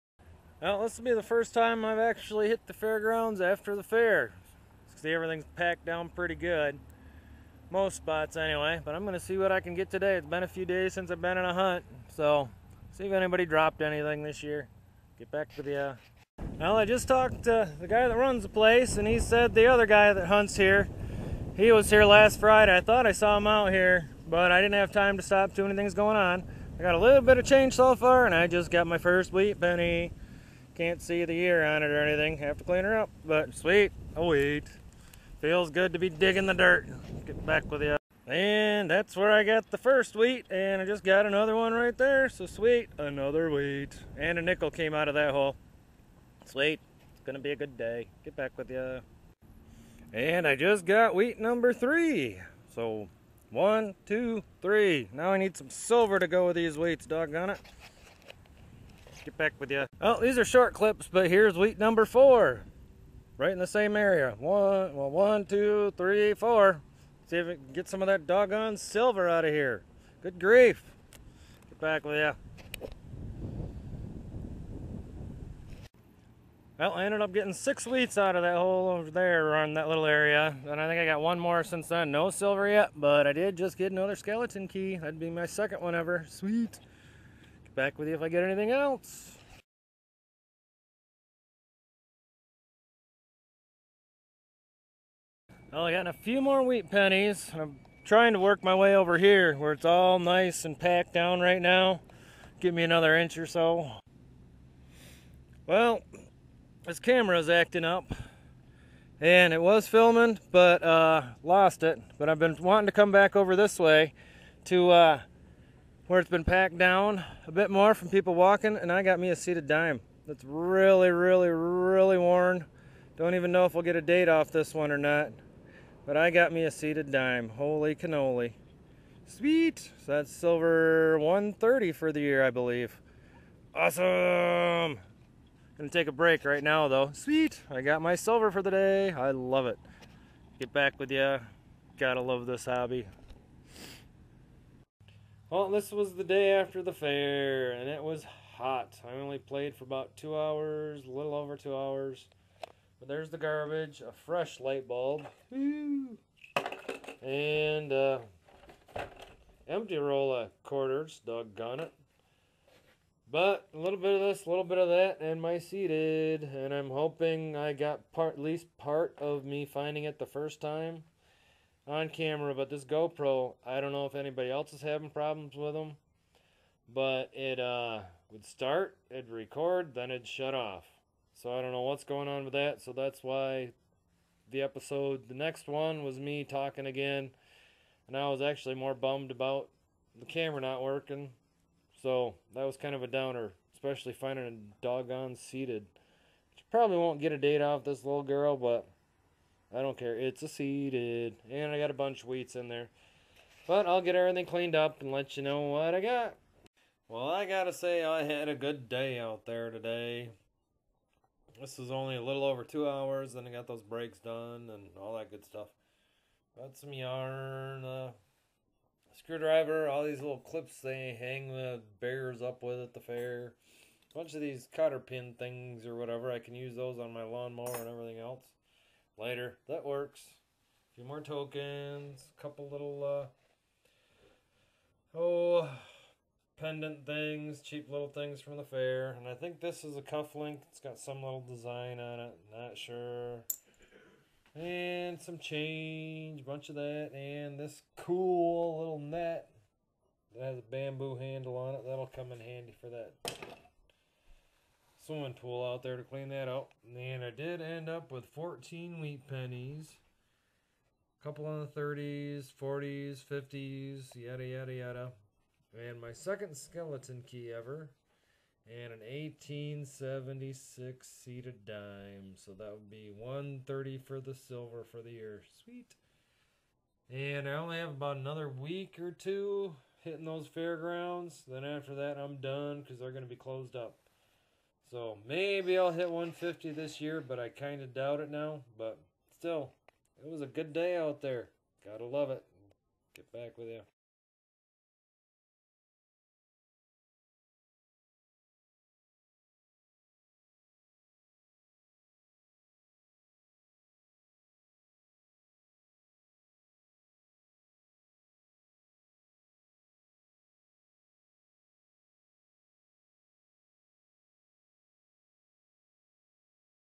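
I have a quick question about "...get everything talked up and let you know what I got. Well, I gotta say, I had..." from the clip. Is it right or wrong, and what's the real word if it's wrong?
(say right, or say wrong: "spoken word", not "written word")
wrong: "cleaned", not "talked".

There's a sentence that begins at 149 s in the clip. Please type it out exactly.
I only played for about two hours, a little over two hours.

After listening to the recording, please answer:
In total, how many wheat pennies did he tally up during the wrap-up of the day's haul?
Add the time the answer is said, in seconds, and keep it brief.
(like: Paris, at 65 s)
14, at 258 s.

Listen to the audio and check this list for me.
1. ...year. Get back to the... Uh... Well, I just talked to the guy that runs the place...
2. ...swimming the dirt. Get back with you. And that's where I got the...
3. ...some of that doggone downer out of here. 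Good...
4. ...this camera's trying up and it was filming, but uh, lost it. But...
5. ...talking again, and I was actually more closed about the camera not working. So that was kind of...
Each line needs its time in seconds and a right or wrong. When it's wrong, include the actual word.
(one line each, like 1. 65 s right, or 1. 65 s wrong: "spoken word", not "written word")
1. 14 s right
2. 36 s wrong: "digging", not "swimming"
3. 67 s wrong: "silver", not "downer"
4. 106 s wrong: "acting", not "trying"
5. 186 s wrong: "bummed", not "closed".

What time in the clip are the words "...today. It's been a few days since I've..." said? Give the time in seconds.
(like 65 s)
9 s.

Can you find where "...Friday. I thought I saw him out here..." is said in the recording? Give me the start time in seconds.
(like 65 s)
22 s.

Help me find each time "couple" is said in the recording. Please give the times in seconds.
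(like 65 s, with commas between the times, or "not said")
232 s, 261 s.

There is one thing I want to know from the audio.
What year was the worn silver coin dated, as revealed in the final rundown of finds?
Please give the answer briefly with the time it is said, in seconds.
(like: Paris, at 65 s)
1876, at 268 s.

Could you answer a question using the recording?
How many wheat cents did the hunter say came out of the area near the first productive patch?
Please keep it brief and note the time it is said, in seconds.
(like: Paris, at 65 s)
6, at 77 s.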